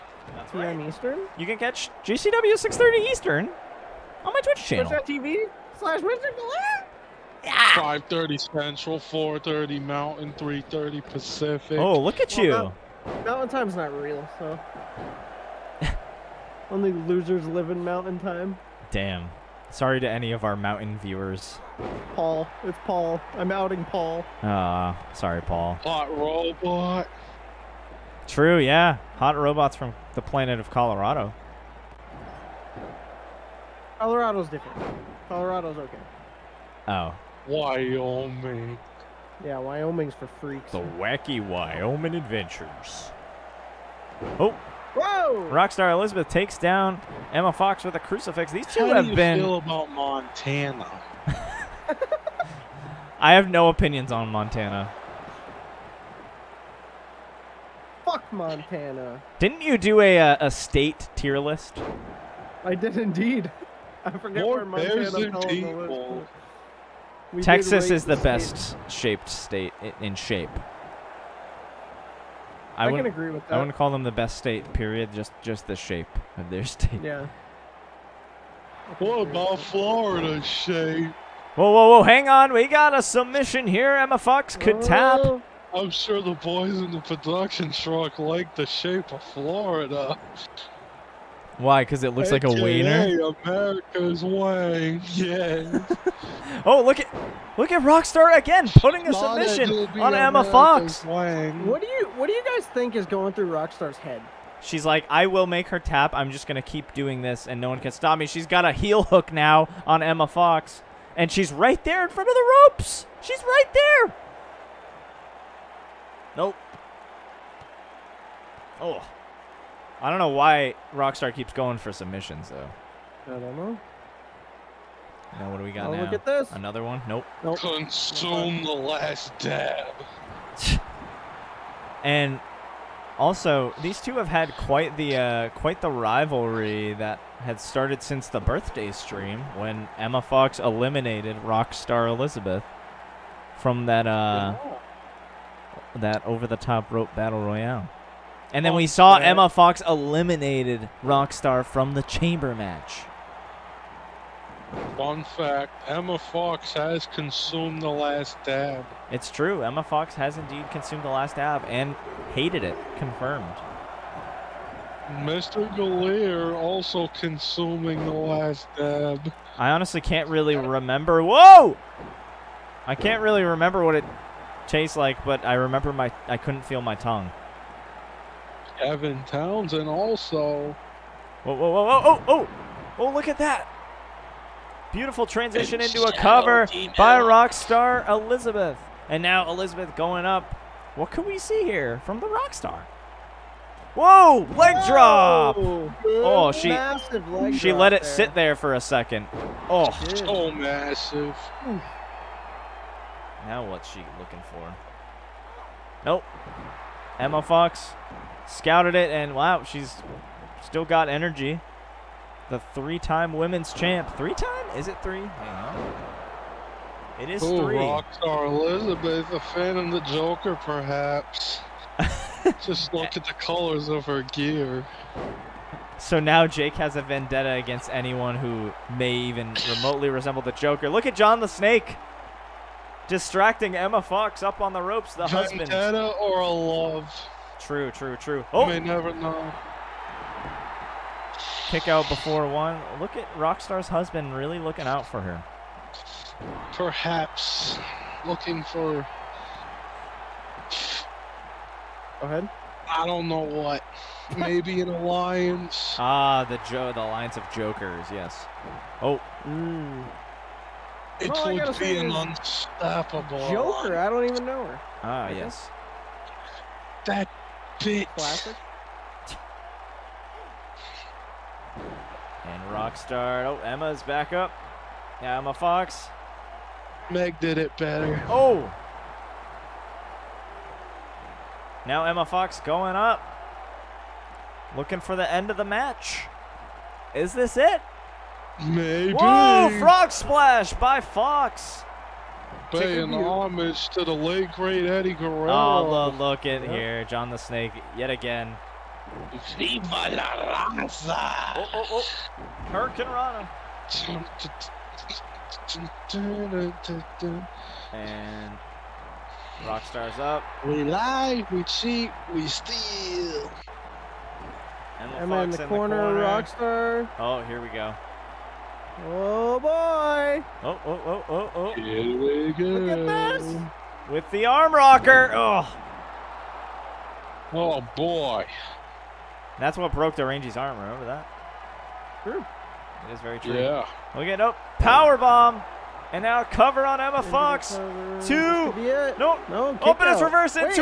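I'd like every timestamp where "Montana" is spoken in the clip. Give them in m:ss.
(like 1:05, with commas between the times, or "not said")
0:49, 0:54, 0:58, 1:04.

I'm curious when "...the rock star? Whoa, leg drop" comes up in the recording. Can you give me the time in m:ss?
3:12.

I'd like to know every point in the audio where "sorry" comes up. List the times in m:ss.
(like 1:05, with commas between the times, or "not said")
0:19, 0:25.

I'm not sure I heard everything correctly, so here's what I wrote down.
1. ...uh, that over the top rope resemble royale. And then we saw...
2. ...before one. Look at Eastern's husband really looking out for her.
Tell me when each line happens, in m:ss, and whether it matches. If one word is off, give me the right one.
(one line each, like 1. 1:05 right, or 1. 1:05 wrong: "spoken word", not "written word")
1. 2:24 wrong: "battle", not "resemble"
2. 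4:02 wrong: "Rockstar", not "Eastern".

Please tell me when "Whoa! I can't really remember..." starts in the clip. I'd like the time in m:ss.
2:51.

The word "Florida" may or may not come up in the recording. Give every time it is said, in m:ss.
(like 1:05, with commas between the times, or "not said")
1:19, 1:29.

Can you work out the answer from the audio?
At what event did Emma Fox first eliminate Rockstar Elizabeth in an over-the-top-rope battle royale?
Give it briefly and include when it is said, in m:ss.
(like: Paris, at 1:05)
the birthday stream, at 2:18.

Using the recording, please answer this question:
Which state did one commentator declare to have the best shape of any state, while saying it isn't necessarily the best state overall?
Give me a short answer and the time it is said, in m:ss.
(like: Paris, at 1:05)
Texas, at 1:07.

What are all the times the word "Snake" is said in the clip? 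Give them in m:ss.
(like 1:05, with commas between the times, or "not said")
3:51, 4:57.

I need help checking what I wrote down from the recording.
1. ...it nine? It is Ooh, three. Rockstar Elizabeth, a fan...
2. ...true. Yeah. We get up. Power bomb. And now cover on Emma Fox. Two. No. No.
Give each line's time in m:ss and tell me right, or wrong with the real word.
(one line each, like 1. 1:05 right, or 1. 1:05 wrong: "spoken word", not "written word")
1. 3:34 wrong: "three", not "nine"
2. 5:33 right.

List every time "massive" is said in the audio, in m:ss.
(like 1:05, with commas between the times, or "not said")
3:20.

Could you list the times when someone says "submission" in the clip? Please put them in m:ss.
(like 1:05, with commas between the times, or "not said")
1:23, 1:39, 2:01.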